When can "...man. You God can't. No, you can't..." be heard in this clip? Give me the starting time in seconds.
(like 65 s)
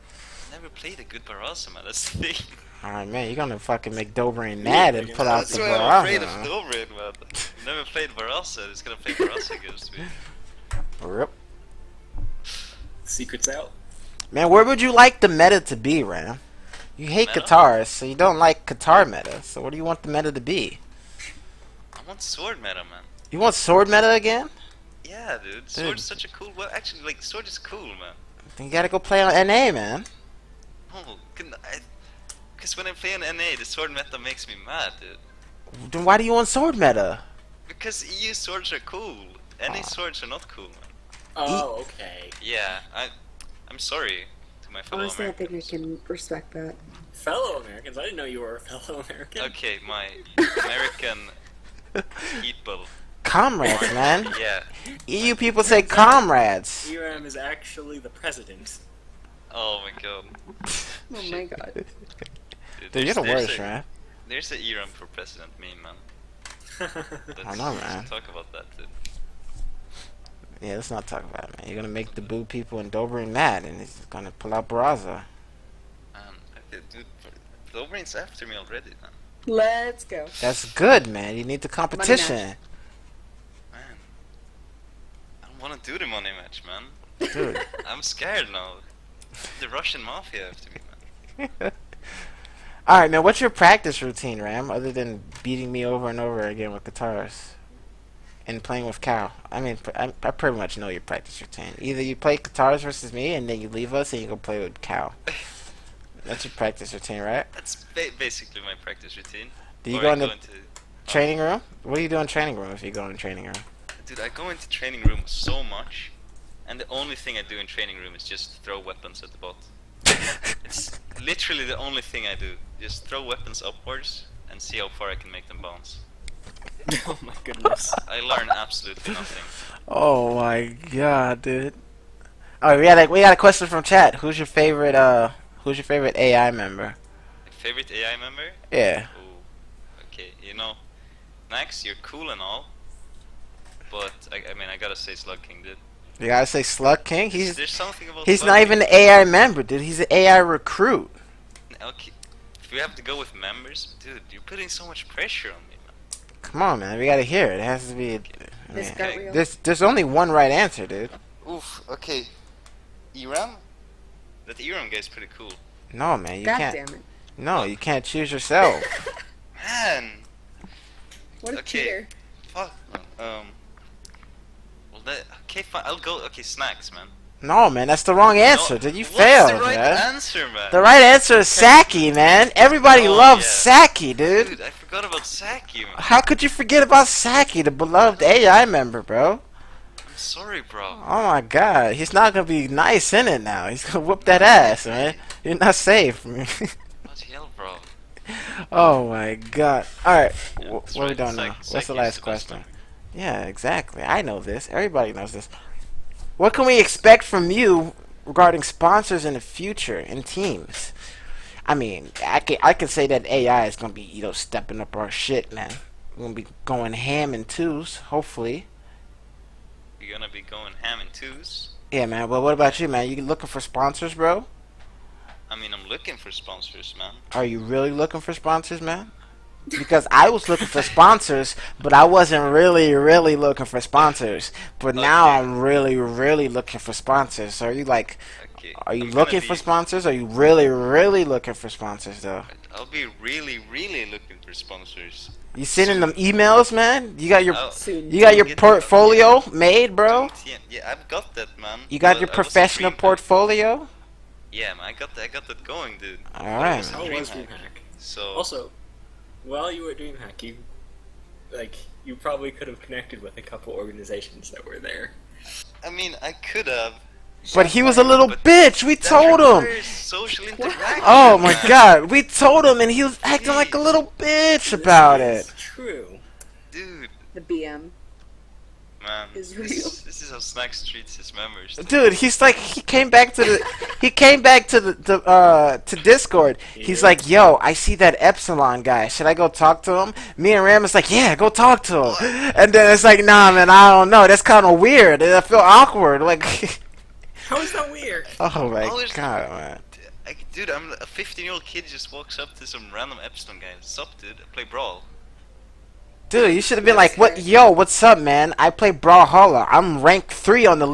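166 s.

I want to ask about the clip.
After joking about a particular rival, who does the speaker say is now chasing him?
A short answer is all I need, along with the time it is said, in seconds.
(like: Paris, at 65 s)
the Russian mafia, at 89 s.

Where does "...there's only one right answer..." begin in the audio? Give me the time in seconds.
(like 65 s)
159 s.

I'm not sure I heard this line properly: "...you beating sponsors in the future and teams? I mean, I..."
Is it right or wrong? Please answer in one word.
wrong.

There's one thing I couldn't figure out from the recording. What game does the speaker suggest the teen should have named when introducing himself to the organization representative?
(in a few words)
Brawlhalla.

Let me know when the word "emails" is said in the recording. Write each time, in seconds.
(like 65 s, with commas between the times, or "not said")
246 s.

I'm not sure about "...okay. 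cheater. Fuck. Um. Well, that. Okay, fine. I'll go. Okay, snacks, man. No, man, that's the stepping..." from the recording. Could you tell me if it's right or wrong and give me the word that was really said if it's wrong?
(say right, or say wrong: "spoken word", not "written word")
wrong: "wrong", not "stepping".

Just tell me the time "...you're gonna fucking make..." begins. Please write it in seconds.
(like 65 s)
3 s.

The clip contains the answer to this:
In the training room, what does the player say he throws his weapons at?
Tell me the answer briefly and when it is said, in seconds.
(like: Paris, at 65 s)
the bot, at 119 s.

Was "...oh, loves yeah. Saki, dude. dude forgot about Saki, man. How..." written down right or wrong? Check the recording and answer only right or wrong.
right.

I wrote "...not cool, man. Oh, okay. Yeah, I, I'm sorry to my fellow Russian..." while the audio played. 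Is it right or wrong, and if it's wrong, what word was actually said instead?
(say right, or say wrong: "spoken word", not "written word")
wrong: "Honestly", not "Russian".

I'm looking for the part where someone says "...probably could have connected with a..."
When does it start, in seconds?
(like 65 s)
262 s.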